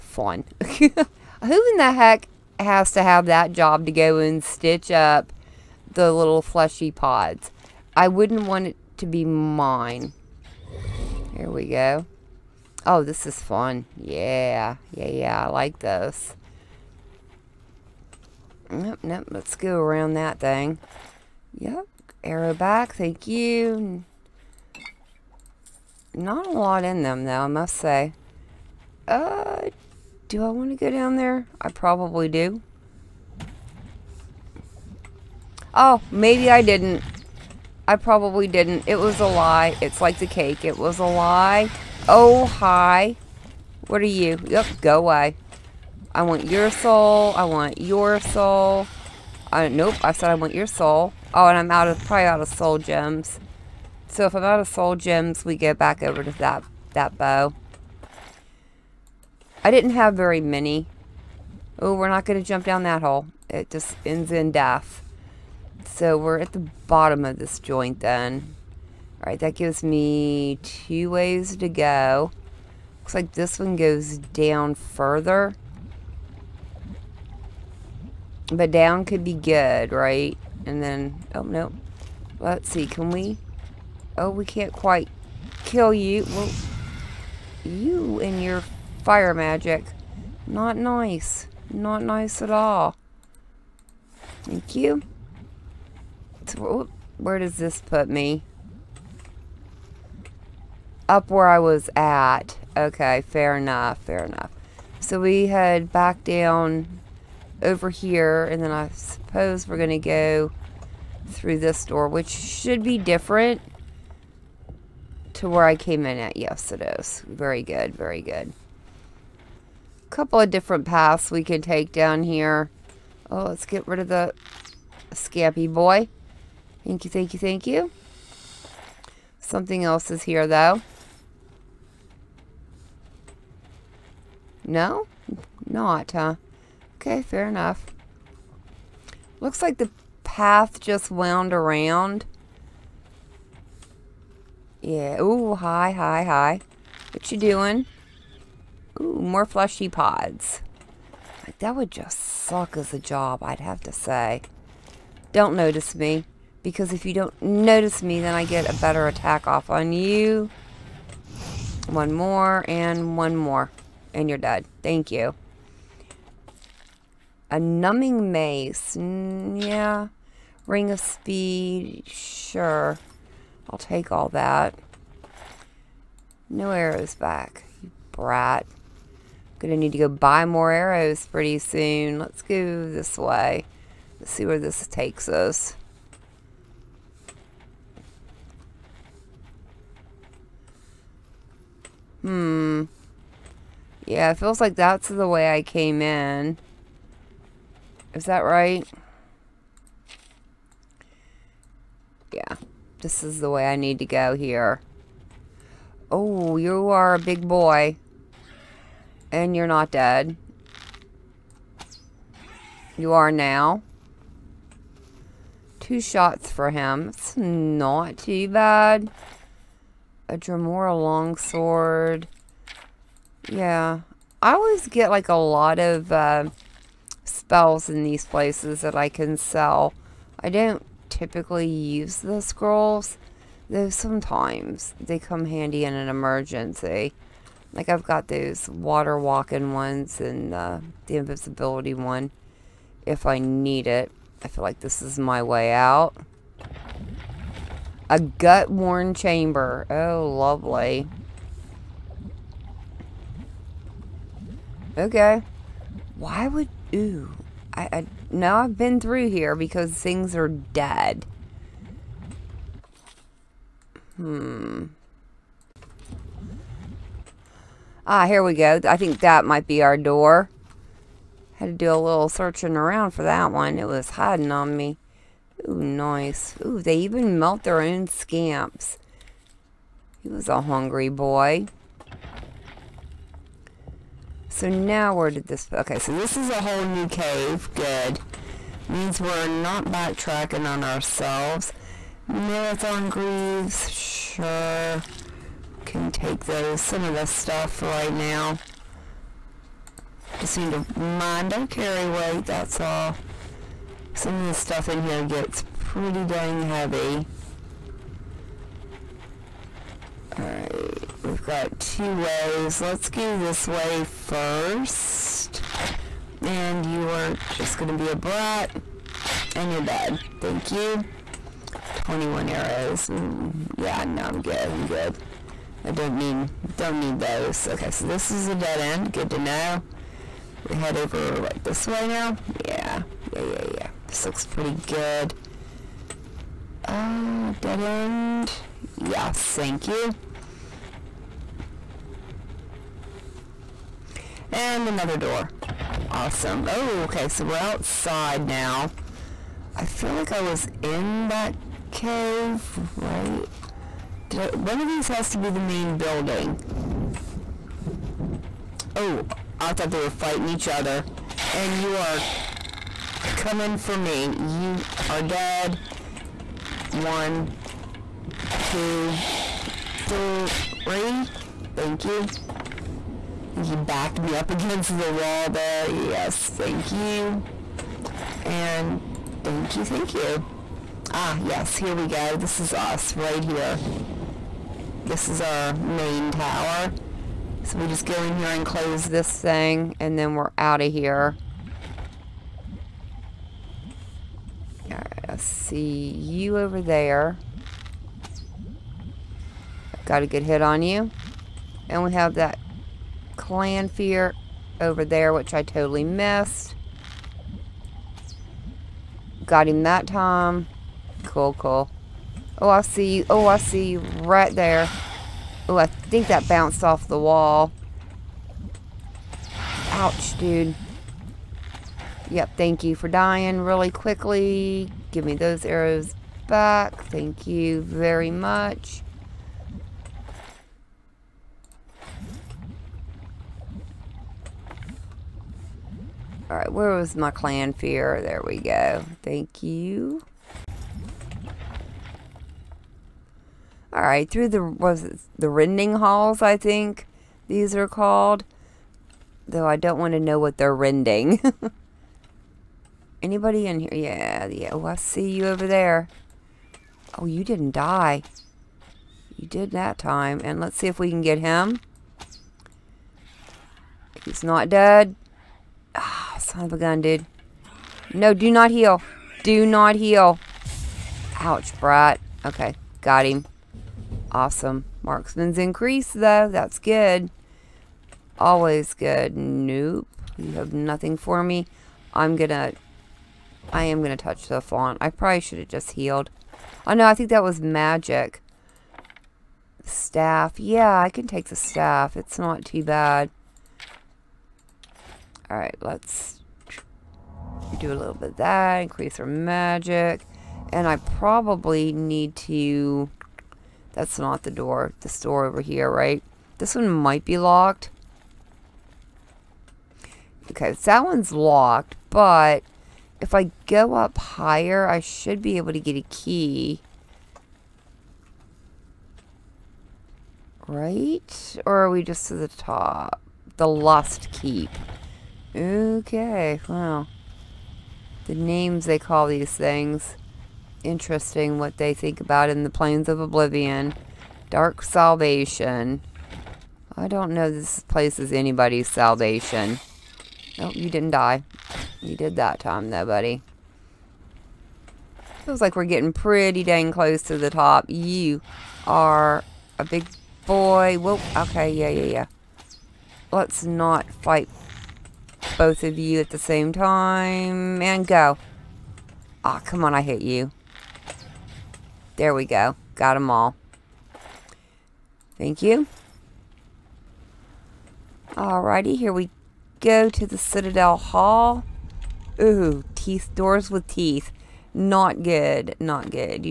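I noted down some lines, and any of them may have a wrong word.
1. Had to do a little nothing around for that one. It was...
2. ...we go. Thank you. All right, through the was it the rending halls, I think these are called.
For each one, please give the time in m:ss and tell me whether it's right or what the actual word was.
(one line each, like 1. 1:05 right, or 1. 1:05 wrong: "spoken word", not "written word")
1. 4:31 wrong: "searching", not "nothing"
2. 7:18 right.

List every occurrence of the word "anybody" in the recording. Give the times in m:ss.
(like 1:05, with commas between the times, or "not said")
7:33, 8:58.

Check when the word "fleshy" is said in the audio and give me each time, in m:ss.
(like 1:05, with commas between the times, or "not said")
0:06, 2:29.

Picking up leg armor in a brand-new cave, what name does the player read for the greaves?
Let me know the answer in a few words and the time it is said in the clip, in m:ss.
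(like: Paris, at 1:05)
Marathon greaves, at 4:52.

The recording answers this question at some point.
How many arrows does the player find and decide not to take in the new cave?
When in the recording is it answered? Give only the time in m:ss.
5:21.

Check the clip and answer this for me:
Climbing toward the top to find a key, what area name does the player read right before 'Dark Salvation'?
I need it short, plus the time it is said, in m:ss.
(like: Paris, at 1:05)
The Lost Keep, at 8:43.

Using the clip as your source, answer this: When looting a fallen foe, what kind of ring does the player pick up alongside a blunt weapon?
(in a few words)
Ring of speed.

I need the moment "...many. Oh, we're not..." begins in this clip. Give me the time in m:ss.
1:00.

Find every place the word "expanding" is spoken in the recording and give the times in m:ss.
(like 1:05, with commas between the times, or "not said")
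not said.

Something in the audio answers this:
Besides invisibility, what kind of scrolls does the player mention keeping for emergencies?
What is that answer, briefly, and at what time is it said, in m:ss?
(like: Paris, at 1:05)
water walking, at 3:58.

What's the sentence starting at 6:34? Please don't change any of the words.
Alright, I see you over there.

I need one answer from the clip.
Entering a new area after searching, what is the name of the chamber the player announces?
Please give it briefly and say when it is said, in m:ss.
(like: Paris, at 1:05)
gut-worn chamber, at 4:08.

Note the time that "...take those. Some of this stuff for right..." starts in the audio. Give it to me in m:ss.
4:56.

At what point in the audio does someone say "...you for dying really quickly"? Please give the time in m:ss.
7:02.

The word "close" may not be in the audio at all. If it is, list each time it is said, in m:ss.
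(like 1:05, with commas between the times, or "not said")
6:28, 9:06.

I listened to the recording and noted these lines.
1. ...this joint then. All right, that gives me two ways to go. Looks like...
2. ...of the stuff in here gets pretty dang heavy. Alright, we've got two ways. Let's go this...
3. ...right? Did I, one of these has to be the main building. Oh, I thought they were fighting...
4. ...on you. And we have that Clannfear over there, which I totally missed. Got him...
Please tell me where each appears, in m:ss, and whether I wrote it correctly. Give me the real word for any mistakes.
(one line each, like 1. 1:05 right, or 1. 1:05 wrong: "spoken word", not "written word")
1. 1:07 right
2. 5:04 right
3. 5:52 right
4. 6:40 right.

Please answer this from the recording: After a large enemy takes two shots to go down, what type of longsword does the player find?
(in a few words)
Dremora longsword.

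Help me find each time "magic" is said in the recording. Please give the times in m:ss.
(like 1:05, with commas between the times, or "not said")
1:29, 8:07, 8:19.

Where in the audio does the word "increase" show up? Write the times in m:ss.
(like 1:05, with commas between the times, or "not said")
7:55, 8:18.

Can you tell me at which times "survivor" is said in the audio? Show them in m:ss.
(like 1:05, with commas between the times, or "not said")
not said.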